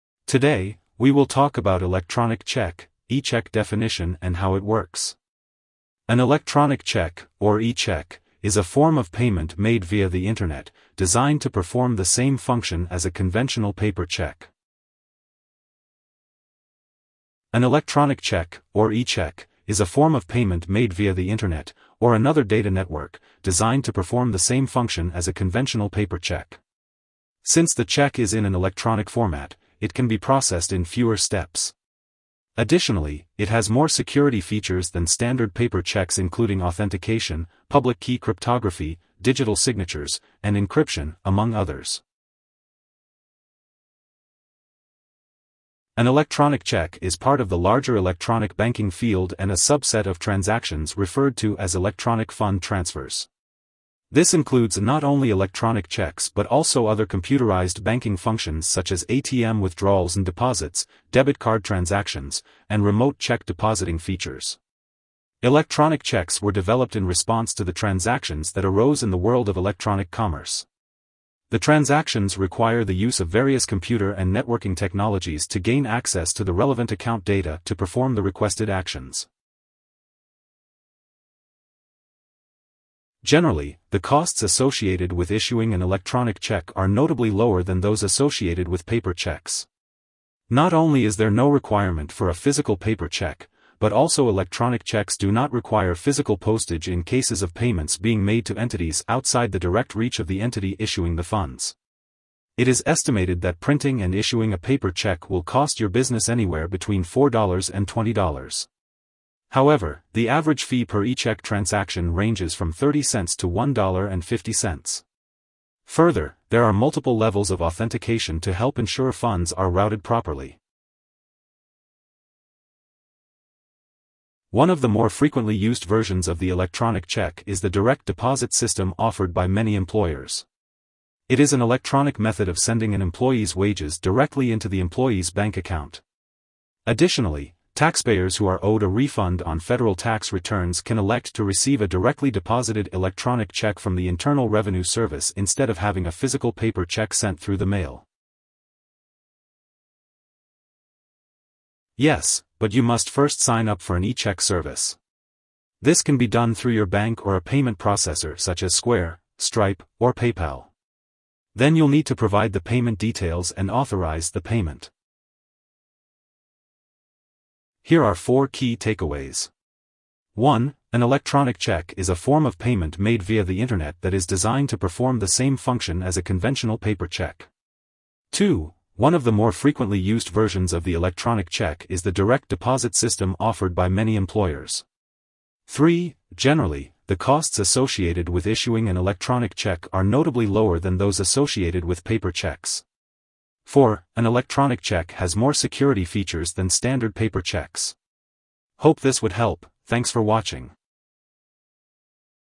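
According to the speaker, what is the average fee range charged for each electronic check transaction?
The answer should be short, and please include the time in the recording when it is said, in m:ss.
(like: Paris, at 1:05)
30 cents to $1.50, at 1:52.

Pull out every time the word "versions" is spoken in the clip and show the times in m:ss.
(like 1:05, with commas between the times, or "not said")
2:05, 3:00.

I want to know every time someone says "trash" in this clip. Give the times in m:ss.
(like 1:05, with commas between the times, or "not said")
not said.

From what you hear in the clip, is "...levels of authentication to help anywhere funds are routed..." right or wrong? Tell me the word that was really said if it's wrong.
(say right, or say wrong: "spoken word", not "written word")
wrong: "ensure", not "anywhere".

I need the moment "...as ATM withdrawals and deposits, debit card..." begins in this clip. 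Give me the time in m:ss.
0:58.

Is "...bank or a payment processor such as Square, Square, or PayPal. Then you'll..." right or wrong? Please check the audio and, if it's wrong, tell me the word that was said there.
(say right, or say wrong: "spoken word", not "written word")
wrong: "Stripe", not "Square".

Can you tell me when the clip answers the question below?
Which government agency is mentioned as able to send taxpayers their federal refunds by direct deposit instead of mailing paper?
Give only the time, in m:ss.
2:24.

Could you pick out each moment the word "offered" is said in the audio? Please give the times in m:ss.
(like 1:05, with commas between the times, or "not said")
2:08, 3:03.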